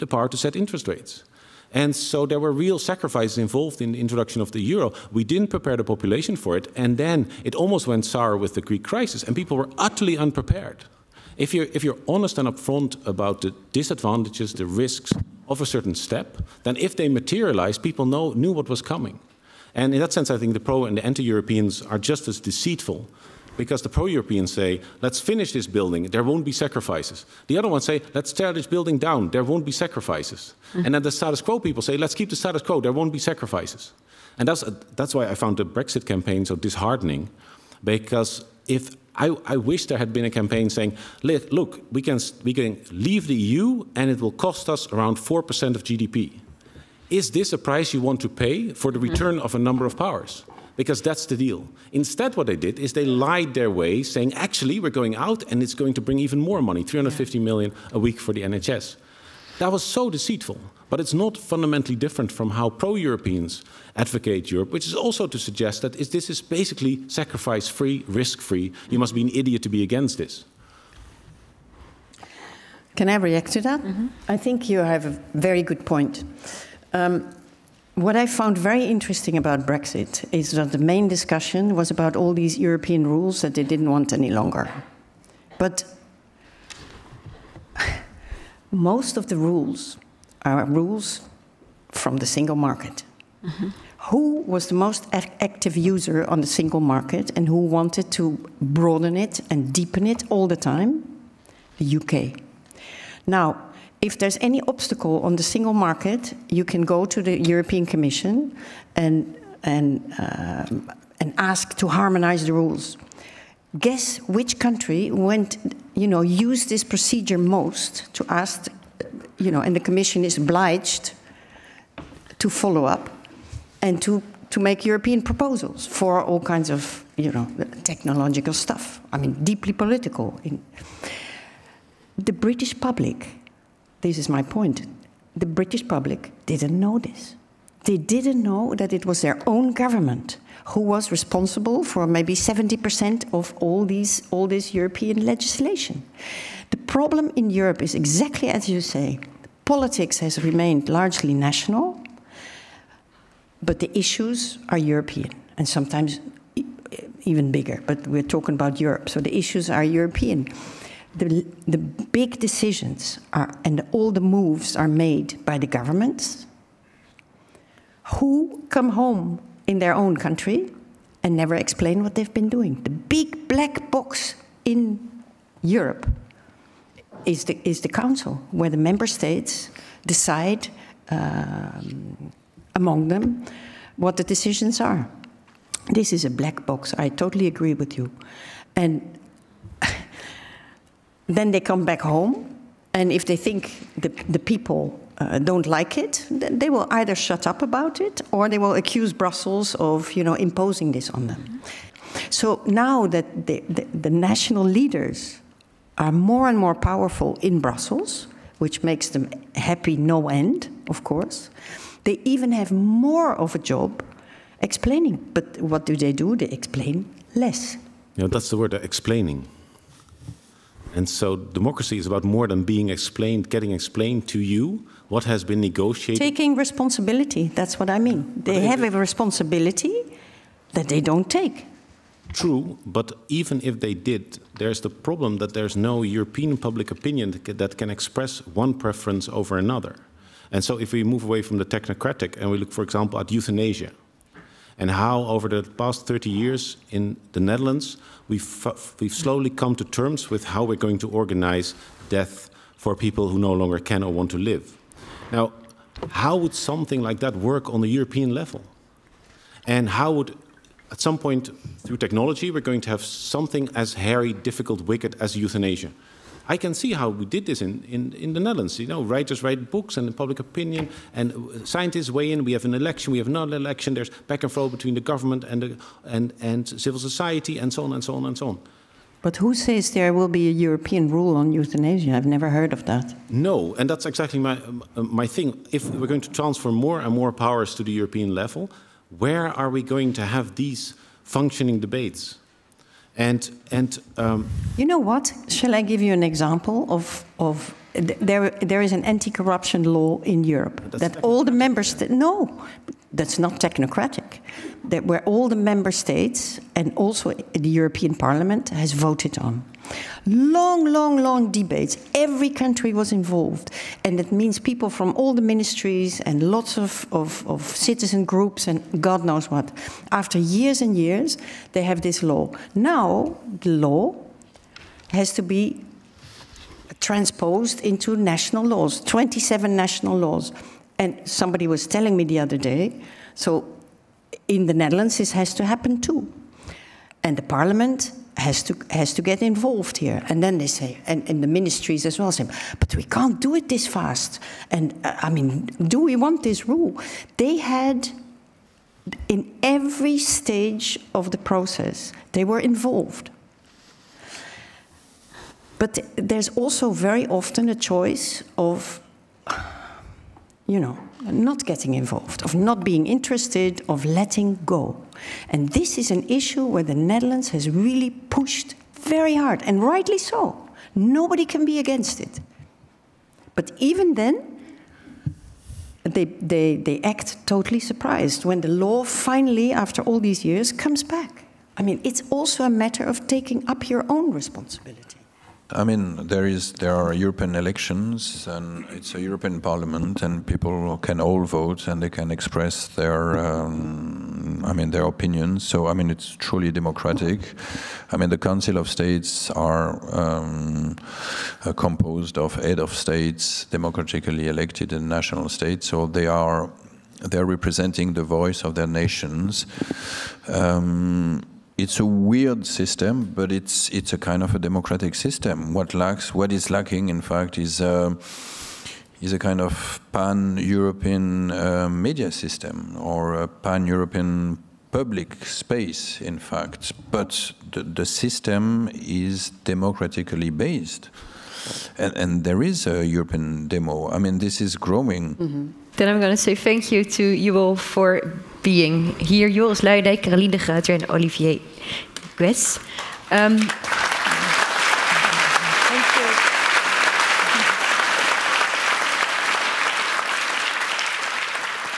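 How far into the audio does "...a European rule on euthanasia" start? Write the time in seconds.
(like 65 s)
280 s.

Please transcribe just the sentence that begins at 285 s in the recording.
If we're going to transfer more and more powers to the European level, where are we going to have these functioning debates?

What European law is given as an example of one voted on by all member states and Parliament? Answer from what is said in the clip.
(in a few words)
Anti-corruption law.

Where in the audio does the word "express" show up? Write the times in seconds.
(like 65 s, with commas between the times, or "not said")
237 s, 392 s.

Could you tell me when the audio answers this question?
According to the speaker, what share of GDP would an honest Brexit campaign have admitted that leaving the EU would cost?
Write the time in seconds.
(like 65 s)
45 s.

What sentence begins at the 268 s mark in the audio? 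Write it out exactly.
You know, writers write books and public opinion, and scientists weigh in.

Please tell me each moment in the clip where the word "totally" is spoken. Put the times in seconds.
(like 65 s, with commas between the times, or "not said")
187 s, 377 s.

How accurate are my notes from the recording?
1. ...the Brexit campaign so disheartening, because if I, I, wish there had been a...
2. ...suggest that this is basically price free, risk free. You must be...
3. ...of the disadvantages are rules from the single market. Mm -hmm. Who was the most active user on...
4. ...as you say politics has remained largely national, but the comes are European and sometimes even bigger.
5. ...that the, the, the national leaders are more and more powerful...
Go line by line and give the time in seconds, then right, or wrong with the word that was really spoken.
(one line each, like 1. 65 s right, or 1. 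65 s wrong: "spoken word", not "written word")
1. 35 s right
2. 65 s wrong: "sacrifice", not "price"
3. 89 s wrong: "rules", not "disadvantages"
4. 148 s wrong: "issues", not "comes"
5. 203 s right.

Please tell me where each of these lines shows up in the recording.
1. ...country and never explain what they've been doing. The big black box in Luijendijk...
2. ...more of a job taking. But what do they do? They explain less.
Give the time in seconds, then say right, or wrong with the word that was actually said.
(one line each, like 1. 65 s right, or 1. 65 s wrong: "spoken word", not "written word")
1. 170 s wrong: "Europe", not "Luijendijk"
2. 212 s wrong: "explaining", not "taking".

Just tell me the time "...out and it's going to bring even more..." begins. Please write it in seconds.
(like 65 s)
55 s.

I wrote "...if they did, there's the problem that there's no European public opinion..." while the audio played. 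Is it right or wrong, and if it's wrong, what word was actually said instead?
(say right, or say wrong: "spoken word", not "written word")
right.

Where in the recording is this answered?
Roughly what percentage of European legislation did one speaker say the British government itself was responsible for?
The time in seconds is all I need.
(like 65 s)
142 s.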